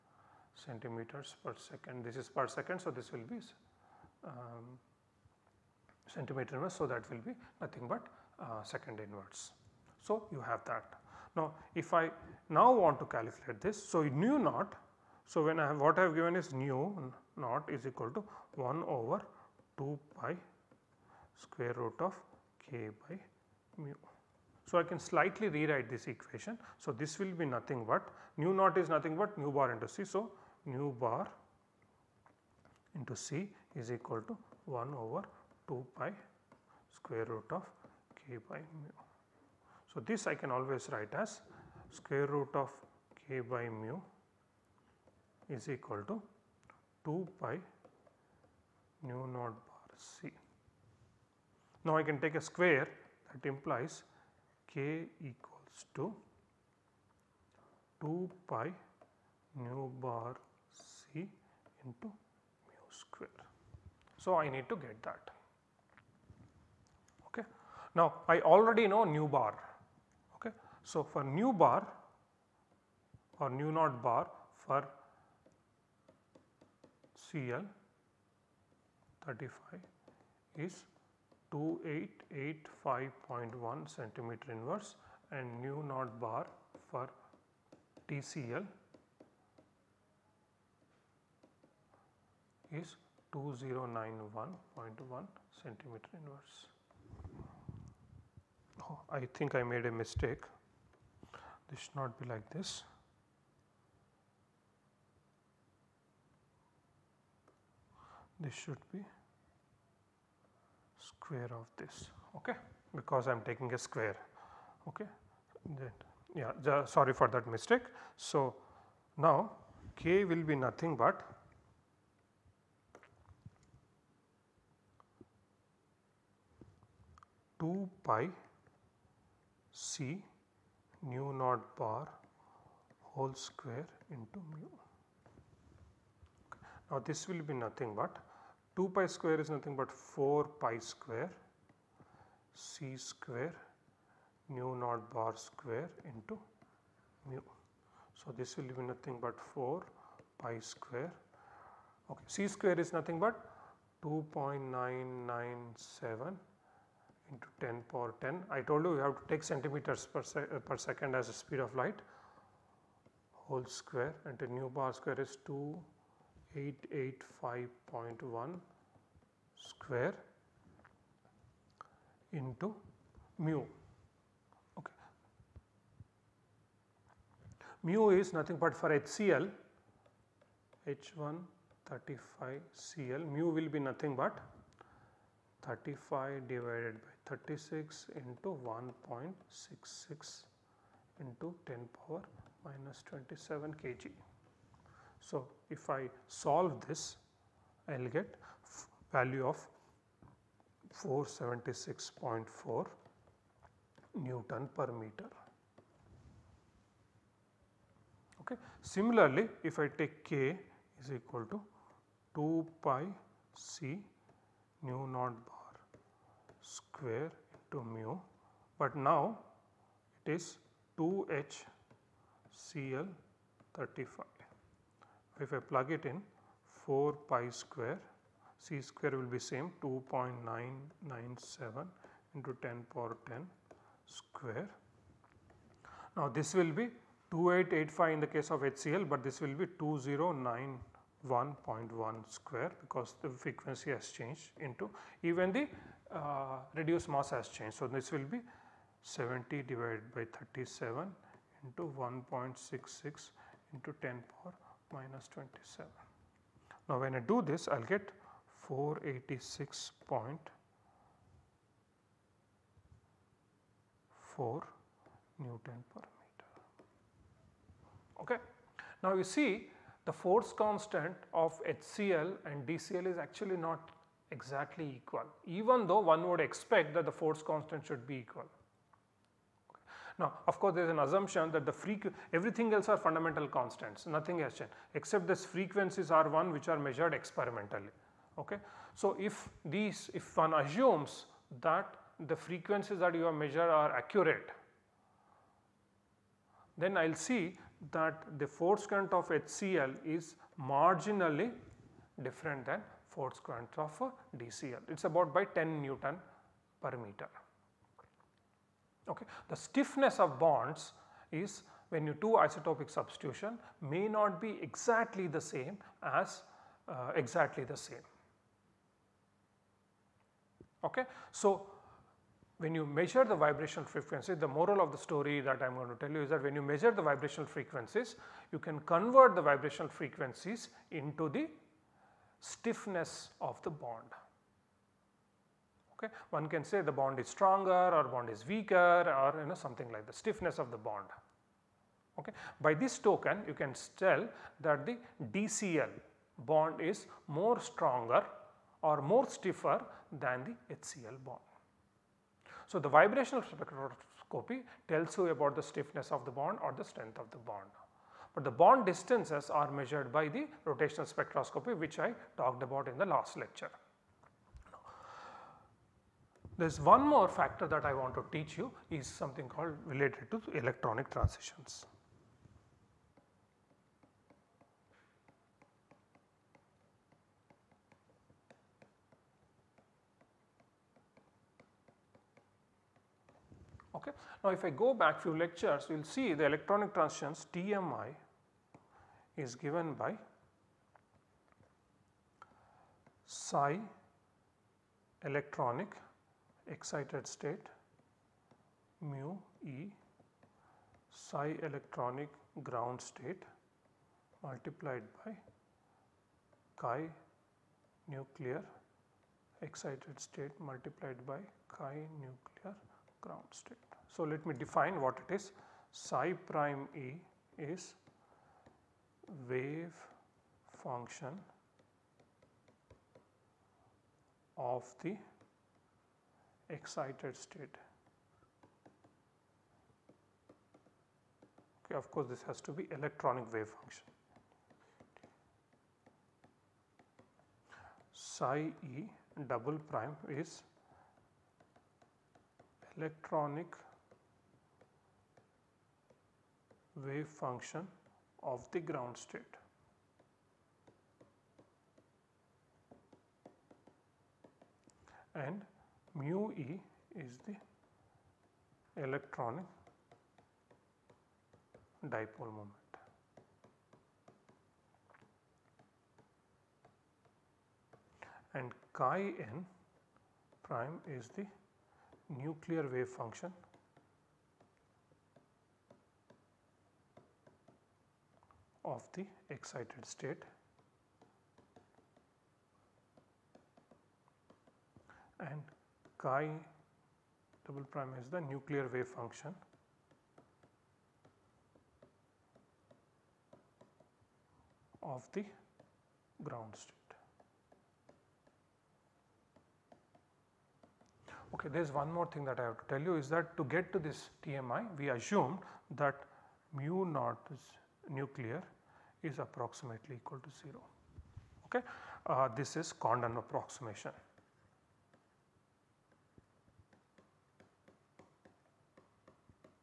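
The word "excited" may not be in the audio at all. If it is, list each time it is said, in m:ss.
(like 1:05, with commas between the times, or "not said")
6:36, 6:49, 7:06, 7:59.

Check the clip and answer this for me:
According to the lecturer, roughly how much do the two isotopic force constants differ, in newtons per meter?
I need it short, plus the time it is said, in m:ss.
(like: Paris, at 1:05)
10 N/m, at 5:05.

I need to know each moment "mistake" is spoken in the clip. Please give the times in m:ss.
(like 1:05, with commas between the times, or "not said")
1:39, 1:57.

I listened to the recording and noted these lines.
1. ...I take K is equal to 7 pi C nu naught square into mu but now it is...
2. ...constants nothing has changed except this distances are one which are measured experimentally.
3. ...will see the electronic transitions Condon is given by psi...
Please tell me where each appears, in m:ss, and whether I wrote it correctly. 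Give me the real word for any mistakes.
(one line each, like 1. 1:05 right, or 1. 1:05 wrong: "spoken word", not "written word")
1. 3:29 wrong: "2", not "7"
2. 4:43 wrong: "frequencies", not "distances"
3. 6:25 wrong: "TMI", not "Condon".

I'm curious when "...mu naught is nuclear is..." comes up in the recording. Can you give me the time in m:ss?
8:26.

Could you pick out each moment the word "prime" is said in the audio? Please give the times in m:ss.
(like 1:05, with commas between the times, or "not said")
6:56, 7:19, 7:50, 8:07.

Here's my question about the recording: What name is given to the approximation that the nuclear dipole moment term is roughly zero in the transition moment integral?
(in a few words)
Condon approximation.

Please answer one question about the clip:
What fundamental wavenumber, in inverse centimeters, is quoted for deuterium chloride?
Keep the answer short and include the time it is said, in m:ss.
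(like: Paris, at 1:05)
2091.1, at 1:33.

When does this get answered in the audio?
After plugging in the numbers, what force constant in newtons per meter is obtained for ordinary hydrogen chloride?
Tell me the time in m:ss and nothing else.
3:21.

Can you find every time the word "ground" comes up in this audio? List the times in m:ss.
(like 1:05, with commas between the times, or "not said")
6:42, 6:53, 7:28, 8:16.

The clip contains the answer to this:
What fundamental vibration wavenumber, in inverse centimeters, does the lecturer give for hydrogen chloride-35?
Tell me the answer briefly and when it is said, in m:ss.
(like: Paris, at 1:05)
2885.1, at 1:21.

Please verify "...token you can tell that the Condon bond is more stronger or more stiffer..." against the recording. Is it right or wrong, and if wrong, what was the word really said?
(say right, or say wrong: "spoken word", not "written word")
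wrong: "DCL", not "Condon".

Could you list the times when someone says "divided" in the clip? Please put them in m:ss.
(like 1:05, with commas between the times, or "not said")
3:06, 4:09.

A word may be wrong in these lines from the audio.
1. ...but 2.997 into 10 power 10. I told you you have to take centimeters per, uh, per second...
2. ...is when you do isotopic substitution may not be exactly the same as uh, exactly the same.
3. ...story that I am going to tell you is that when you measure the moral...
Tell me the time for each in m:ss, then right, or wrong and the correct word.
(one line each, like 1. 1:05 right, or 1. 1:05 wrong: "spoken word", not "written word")
1. 2:33 right
2. 5:11 right
3. 5:24 wrong: "vibrational", not "moral".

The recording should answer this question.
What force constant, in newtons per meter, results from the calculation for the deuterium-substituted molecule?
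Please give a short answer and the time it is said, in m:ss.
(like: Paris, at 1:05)
486.4 N/m, at 4:18.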